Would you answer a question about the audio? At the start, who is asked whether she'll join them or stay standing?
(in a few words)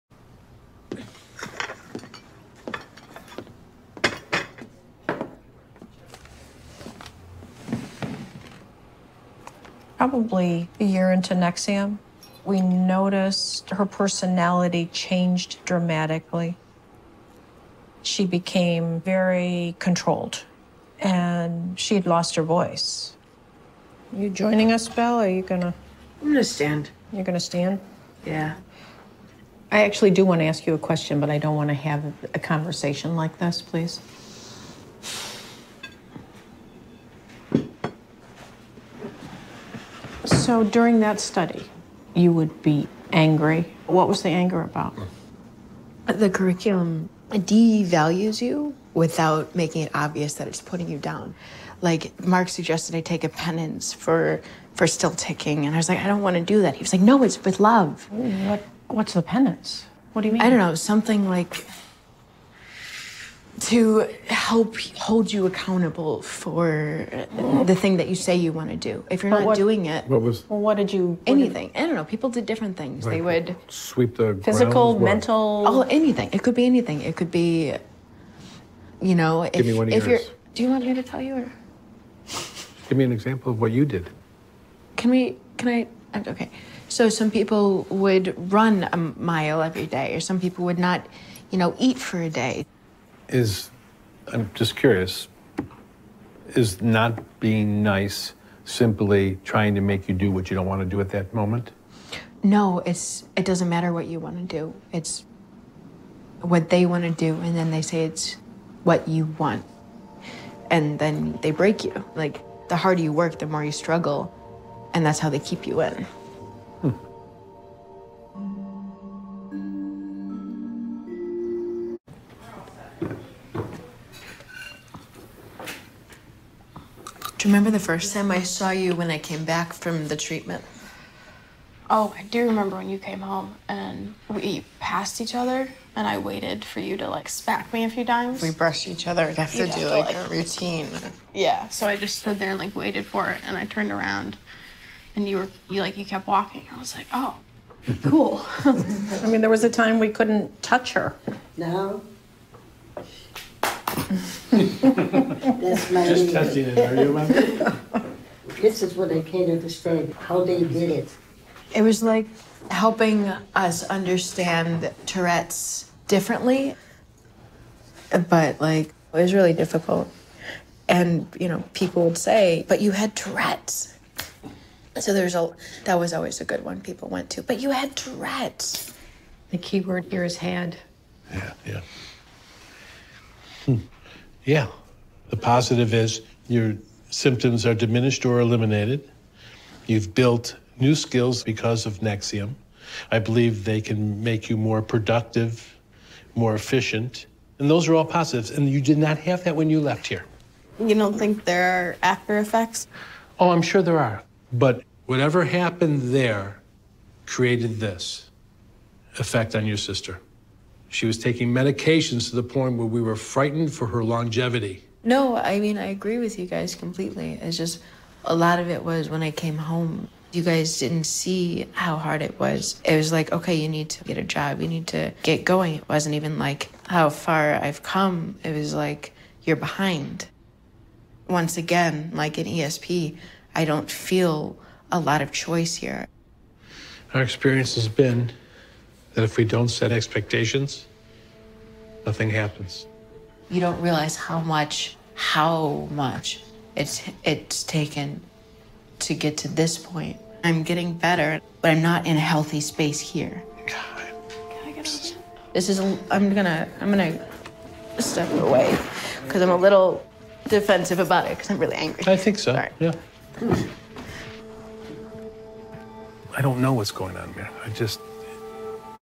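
Belle.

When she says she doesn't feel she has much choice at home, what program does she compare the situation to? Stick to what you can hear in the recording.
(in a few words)
ESP.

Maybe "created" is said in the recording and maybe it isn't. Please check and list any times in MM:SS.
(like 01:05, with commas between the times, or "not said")
03:27.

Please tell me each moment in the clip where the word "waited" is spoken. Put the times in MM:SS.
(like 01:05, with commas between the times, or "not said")
02:16, 02:22.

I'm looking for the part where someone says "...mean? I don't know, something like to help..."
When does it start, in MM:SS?
01:00.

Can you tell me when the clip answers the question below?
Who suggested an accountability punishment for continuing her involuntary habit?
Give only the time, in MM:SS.
00:52.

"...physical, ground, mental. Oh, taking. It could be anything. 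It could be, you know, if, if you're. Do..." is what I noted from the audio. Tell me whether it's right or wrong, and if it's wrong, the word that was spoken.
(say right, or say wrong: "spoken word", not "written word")
wrong: "anything", not "taking".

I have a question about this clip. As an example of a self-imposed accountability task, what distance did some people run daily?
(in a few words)
a mile.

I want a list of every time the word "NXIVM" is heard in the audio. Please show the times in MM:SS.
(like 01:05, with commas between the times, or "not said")
00:11, 03:12.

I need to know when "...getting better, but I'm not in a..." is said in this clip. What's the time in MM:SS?
04:10.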